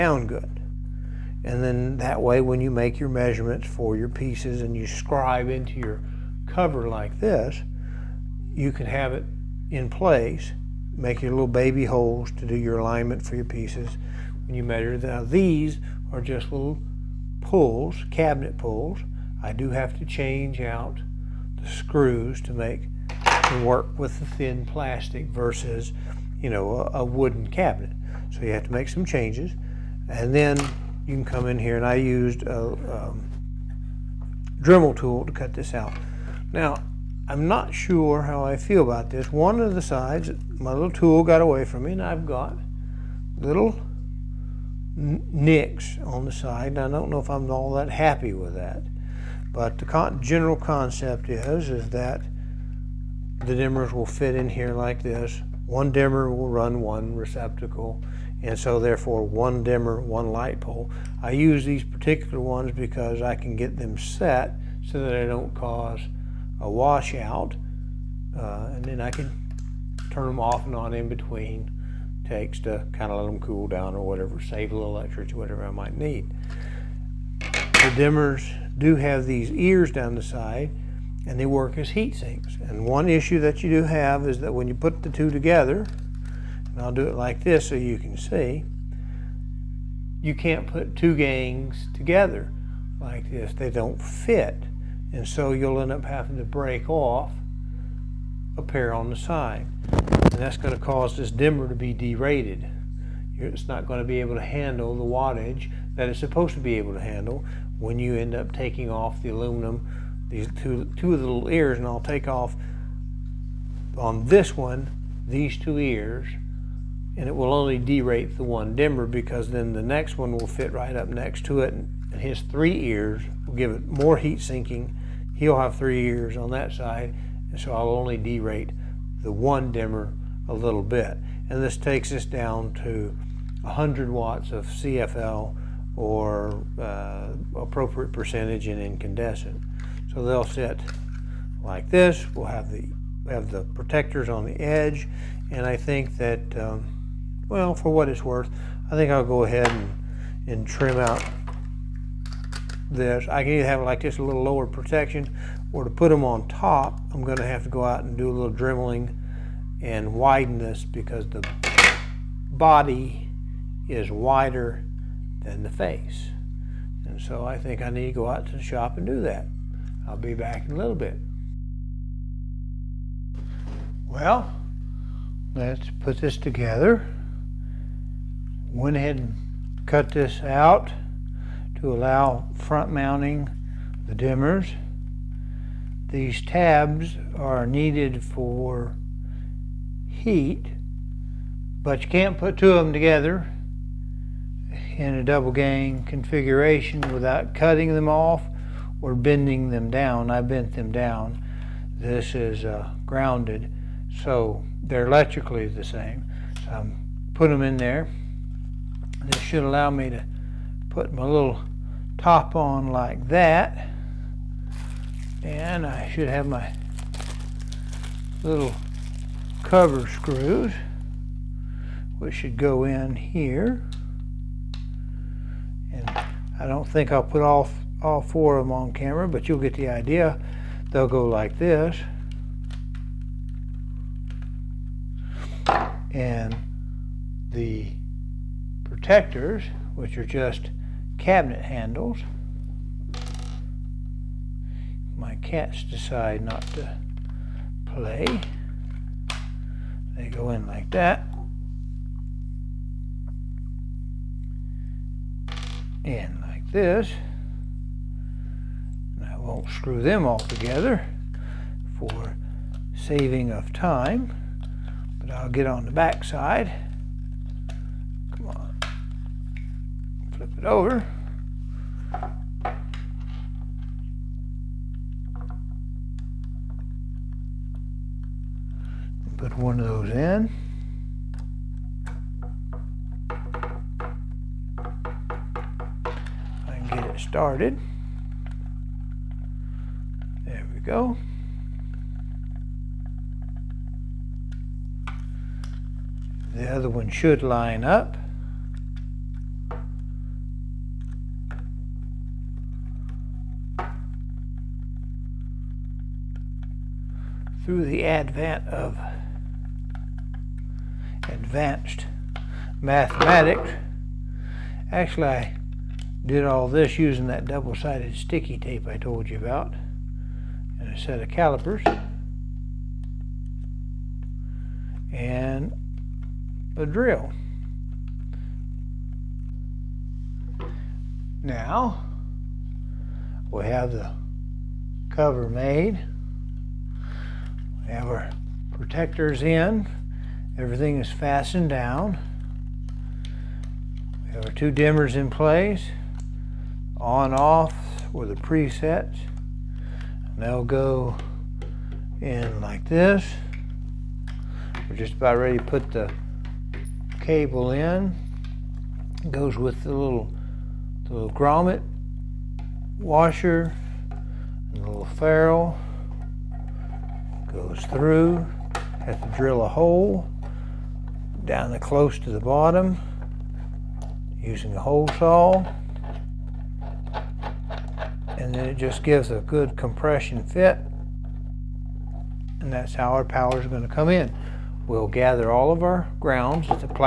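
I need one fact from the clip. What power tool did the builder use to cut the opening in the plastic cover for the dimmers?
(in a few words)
Dremel tool.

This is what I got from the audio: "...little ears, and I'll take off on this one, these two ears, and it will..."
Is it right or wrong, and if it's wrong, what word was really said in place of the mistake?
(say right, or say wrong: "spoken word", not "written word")
right.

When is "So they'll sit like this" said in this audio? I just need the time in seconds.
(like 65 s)
140 s.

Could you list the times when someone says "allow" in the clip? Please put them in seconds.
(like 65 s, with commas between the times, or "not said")
181 s, 209 s.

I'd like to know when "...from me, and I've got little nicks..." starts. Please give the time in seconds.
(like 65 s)
41 s.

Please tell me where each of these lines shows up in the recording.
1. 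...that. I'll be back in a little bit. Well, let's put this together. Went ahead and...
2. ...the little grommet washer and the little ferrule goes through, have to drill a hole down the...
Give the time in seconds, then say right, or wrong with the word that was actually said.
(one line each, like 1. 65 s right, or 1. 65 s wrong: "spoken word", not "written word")
1. 169 s right
2. 361 s right.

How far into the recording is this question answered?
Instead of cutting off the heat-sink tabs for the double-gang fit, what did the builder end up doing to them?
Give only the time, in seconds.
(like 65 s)
200 s.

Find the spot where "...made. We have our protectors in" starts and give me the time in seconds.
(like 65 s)
335 s.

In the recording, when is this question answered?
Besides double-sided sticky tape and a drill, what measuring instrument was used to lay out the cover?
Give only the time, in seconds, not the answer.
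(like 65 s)
321 s.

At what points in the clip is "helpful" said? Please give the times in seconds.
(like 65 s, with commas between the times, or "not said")
not said.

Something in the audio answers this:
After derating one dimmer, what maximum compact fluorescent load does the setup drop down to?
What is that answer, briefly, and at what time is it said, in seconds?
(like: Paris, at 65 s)
100 watts, at 133 s.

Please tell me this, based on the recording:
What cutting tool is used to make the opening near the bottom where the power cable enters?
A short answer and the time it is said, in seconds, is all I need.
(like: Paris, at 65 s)
Hole saw, at 374 s.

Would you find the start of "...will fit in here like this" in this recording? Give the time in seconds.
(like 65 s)
53 s.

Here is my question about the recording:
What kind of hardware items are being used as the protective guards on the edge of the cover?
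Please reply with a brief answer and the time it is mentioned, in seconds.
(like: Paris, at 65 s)
Cabinet pulls, at 18 s.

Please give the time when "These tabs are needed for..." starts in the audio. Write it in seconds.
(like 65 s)
186 s.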